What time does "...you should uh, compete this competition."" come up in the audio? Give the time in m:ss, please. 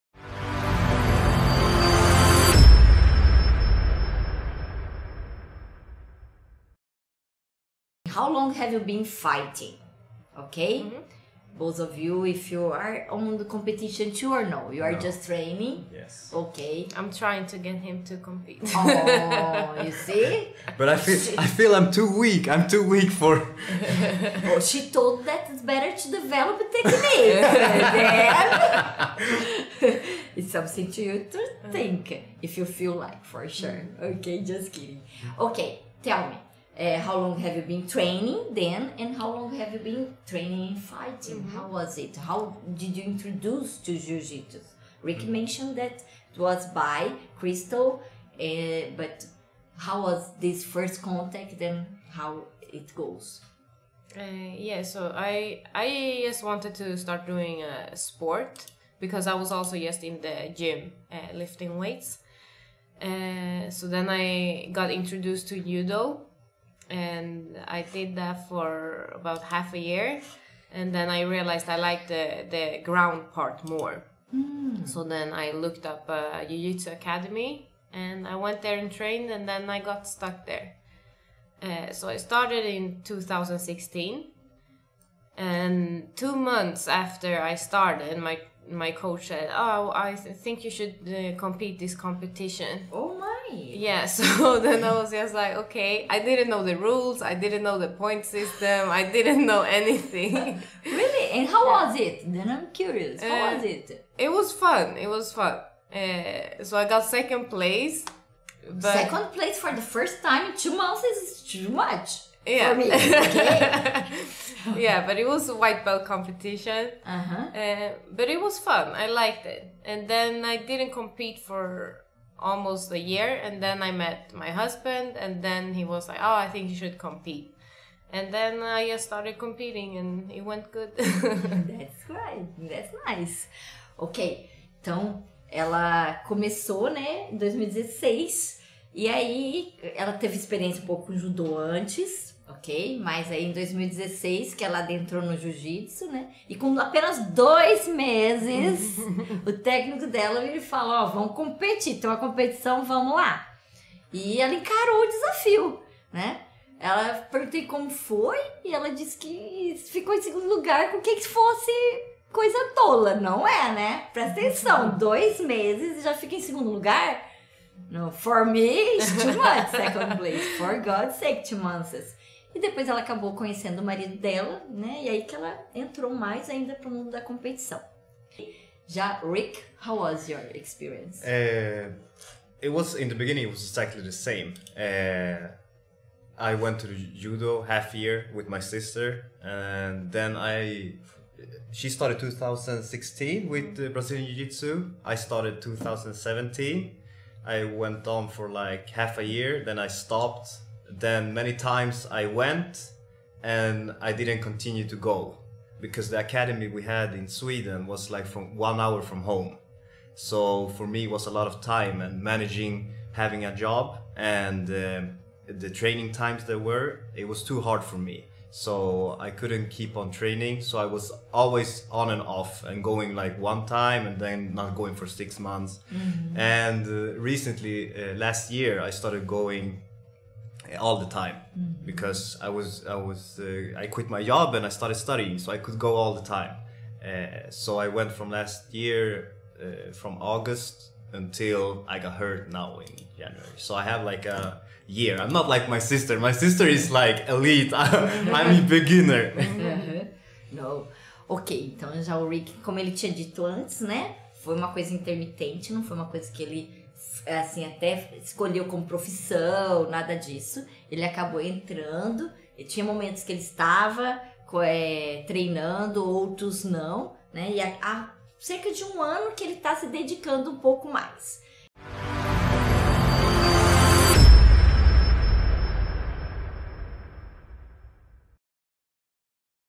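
1:30.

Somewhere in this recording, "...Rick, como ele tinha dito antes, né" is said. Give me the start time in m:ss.
4:12.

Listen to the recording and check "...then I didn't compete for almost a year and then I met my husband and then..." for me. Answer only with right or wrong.
right.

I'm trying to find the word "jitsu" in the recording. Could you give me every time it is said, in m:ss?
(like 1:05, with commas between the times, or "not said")
0:43, 1:16, 2:25, 3:14.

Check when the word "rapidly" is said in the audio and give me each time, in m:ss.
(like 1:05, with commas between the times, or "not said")
not said.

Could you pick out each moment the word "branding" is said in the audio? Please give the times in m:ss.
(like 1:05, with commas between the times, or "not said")
not said.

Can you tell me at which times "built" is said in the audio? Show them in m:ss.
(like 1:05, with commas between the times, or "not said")
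not said.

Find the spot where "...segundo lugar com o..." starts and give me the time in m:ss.
2:40.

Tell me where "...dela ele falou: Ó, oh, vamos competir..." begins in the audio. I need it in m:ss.
2:30.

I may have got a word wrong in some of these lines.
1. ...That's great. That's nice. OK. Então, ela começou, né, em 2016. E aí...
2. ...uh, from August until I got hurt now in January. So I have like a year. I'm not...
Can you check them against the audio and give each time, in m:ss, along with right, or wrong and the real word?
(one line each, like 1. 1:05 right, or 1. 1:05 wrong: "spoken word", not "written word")
1. 2:10 right
2. 3:59 right.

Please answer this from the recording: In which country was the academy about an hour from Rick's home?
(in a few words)
Sweden.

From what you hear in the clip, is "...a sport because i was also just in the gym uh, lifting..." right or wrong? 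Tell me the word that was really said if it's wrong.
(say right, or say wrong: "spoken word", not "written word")
right.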